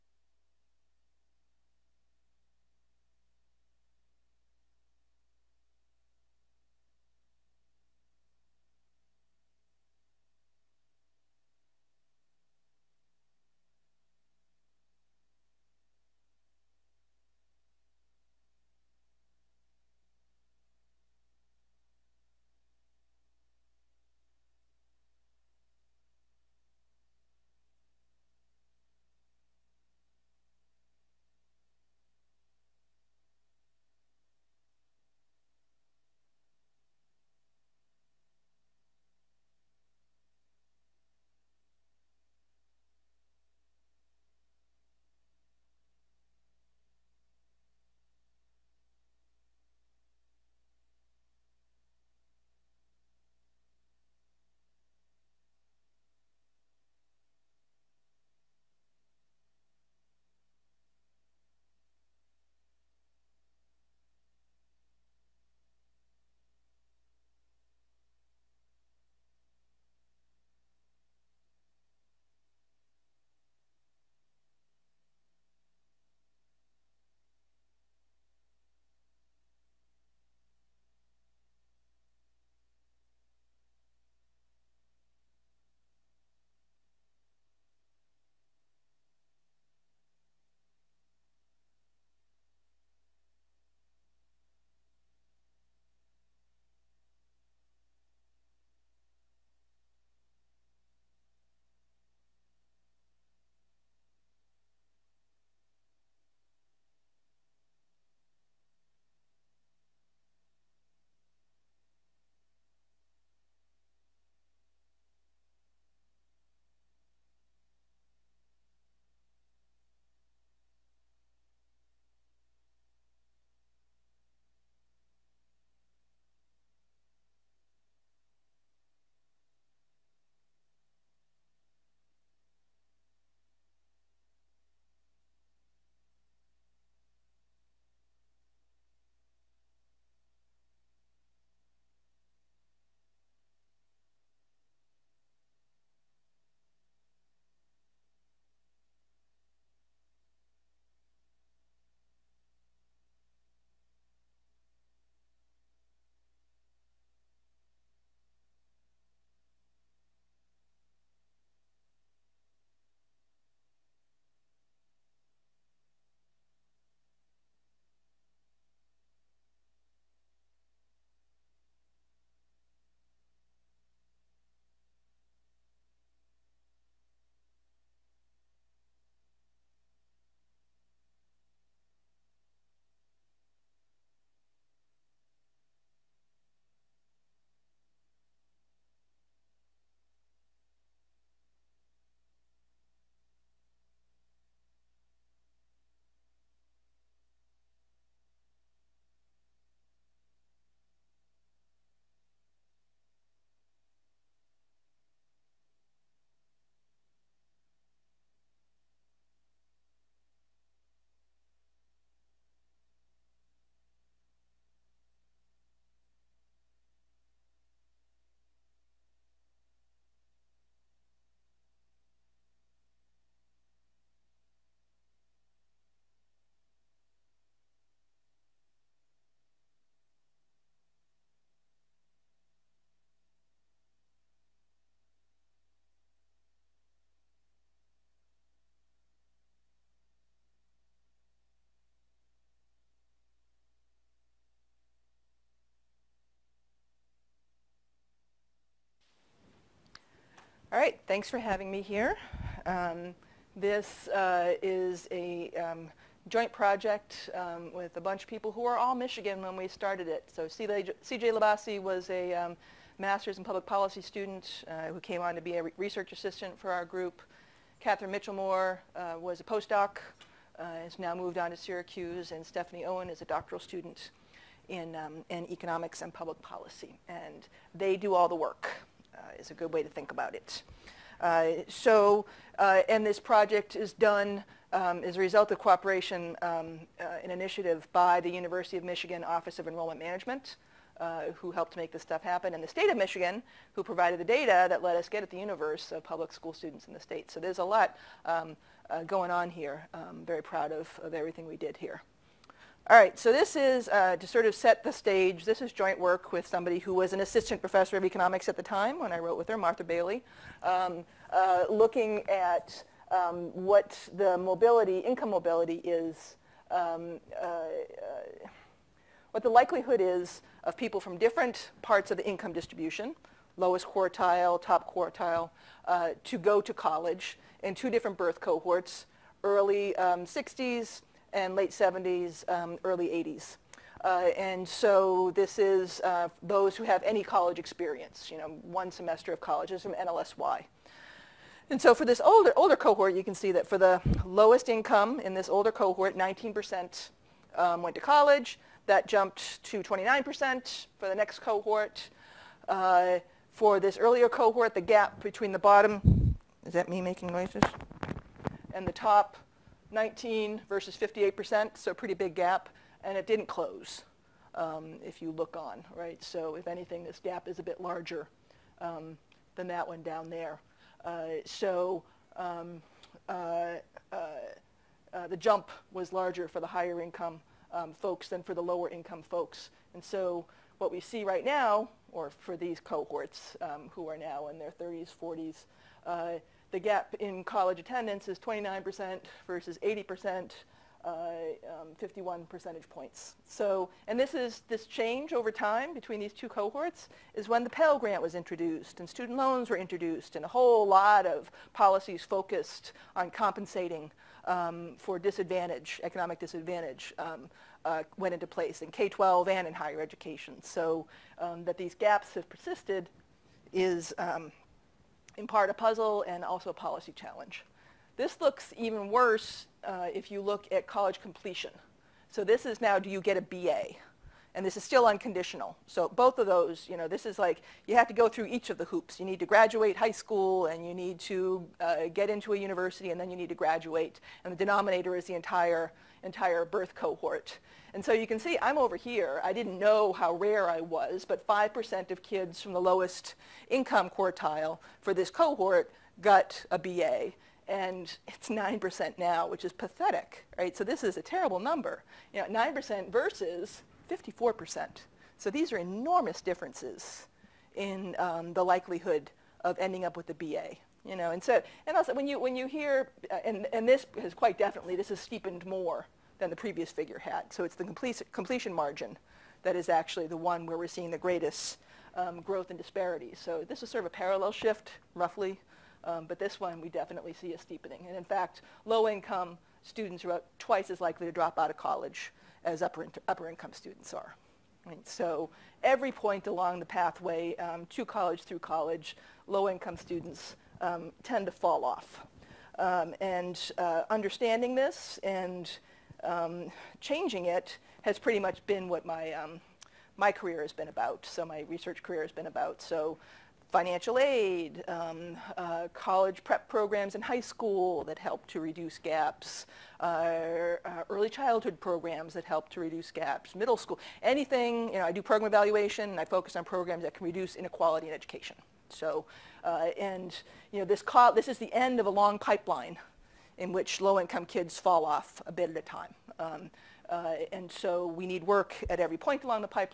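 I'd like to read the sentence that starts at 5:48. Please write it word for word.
That jumped to 29% for the next cohort.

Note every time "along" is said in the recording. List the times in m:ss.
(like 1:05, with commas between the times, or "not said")
8:06, 8:49.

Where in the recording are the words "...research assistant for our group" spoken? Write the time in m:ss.
4:25.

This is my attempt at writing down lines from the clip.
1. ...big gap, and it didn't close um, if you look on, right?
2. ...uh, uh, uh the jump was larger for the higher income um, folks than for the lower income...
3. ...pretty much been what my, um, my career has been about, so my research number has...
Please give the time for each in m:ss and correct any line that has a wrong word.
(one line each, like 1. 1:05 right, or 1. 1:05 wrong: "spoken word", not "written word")
1. 6:02 right
2. 6:13 right
3. 8:18 wrong: "career", not "number".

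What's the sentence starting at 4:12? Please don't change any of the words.
Um, this uh, is a um, joint project um, with a bunch of people who are all Michigan when we started it.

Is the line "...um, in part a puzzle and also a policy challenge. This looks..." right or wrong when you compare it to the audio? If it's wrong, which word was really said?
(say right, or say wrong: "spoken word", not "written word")
right.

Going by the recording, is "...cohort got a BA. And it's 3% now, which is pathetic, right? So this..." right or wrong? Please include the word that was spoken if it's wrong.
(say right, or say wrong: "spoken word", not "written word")
wrong: "9", not "3".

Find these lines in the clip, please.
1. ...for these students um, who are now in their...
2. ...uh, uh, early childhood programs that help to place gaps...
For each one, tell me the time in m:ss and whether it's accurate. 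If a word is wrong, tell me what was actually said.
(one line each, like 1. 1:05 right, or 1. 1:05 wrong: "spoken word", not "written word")
1. 6:22 wrong: "cohorts", not "students"
2. 8:30 wrong: "reduce", not "place".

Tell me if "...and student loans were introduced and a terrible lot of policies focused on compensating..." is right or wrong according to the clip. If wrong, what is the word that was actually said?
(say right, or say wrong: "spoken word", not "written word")
wrong: "whole", not "terrible".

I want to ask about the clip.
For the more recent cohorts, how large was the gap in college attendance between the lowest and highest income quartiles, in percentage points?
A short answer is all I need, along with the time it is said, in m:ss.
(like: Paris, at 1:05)
51, at 6:31.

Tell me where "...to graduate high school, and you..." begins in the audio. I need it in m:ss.
7:09.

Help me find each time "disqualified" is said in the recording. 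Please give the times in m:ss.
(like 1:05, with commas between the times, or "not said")
not said.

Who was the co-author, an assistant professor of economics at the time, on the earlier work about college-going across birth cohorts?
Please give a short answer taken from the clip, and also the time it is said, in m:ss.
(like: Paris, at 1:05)
Martha Bailey, at 5:09.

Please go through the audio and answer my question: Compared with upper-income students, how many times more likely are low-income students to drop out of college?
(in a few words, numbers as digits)
twice.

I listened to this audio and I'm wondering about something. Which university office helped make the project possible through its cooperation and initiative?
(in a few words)
Office of Enrollment Management.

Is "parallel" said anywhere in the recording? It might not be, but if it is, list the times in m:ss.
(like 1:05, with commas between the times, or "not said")
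7:54.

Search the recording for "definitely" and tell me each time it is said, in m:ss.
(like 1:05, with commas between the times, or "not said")
7:44, 7:56.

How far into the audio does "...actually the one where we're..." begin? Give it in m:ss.
7:49.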